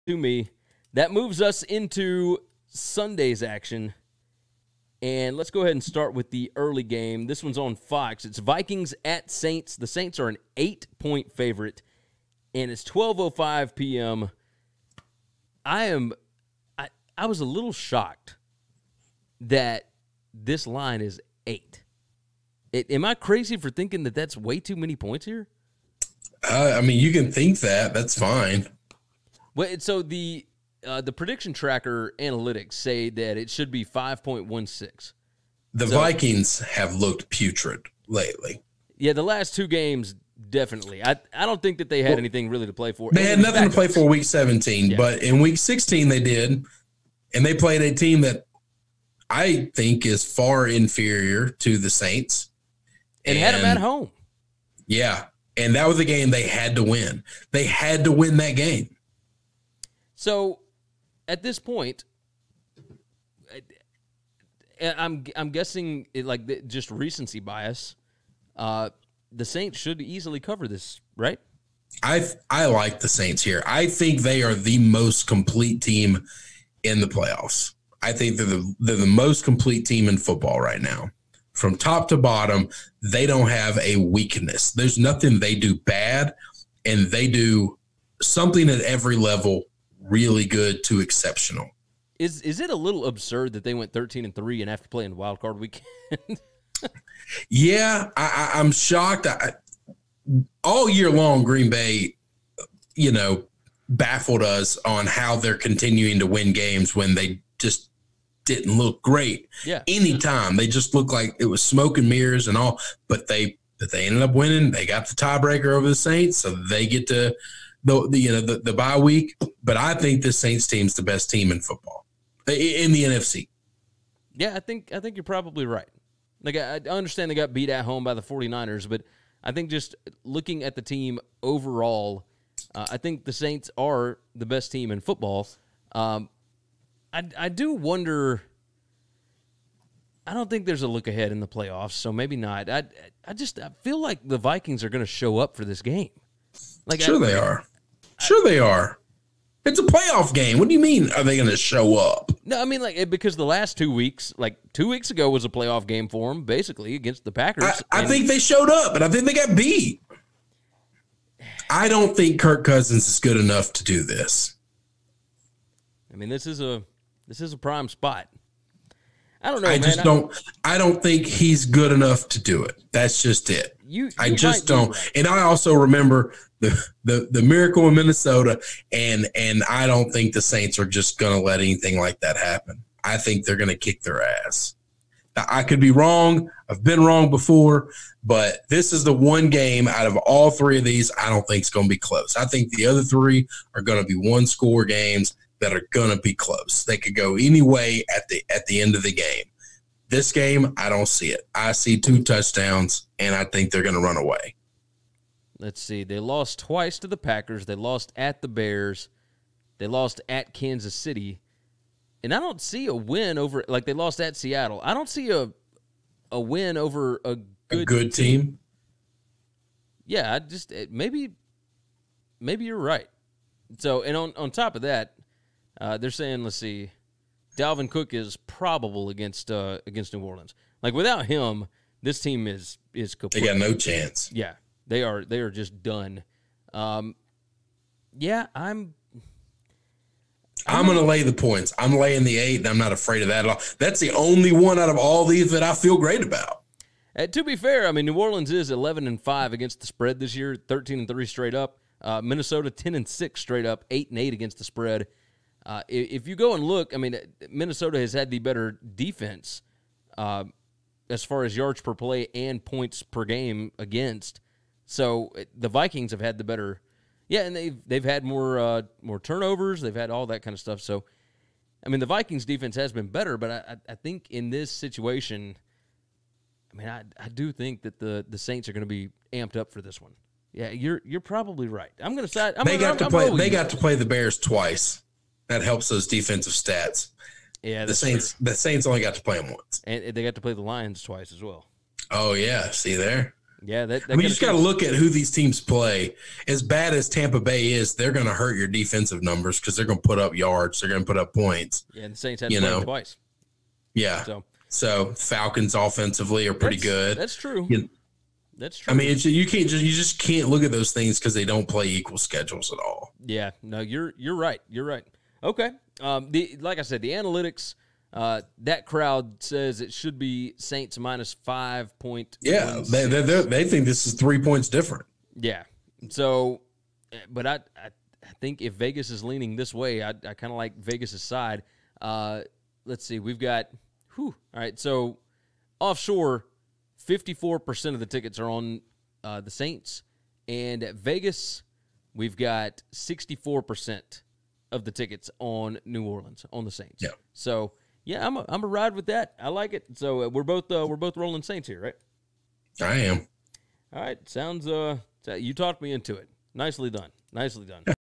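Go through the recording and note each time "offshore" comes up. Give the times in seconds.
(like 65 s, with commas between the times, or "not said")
335 s.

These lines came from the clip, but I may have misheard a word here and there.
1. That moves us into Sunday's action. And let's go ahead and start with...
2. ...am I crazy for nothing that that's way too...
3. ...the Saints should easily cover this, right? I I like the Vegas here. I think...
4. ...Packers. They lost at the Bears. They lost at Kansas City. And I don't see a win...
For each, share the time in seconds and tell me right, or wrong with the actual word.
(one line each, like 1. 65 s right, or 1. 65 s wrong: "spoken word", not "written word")
1. 0 s right
2. 22 s wrong: "thinking", not "nothing"
3. 69 s wrong: "Saints", not "Vegas"
4. 207 s right.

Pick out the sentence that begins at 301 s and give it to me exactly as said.
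Yeah, and the Saints had you know twice.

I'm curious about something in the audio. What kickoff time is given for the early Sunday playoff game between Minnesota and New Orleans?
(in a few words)
12:05 p.m.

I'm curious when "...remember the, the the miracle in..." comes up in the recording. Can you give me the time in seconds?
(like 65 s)
175 s.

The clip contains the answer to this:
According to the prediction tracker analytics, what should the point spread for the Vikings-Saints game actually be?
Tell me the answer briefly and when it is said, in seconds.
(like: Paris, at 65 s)
5.16, at 33 s.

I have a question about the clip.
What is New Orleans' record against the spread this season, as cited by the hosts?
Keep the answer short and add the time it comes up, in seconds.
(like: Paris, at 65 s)
11 and 5, at 248 s.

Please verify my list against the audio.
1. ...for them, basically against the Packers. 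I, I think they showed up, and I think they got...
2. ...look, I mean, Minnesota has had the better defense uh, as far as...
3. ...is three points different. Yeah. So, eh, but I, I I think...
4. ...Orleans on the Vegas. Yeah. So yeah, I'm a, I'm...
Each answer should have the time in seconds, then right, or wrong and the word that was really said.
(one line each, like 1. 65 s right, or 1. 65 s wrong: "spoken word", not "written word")
1. 156 s right
2. 256 s right
3. 324 s right
4. 346 s wrong: "Saints", not "Vegas".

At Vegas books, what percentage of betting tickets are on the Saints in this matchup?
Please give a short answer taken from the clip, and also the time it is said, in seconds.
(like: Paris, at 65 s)
64%, at 342 s.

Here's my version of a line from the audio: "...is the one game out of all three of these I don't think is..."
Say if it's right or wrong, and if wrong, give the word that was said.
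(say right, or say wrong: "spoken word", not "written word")
right.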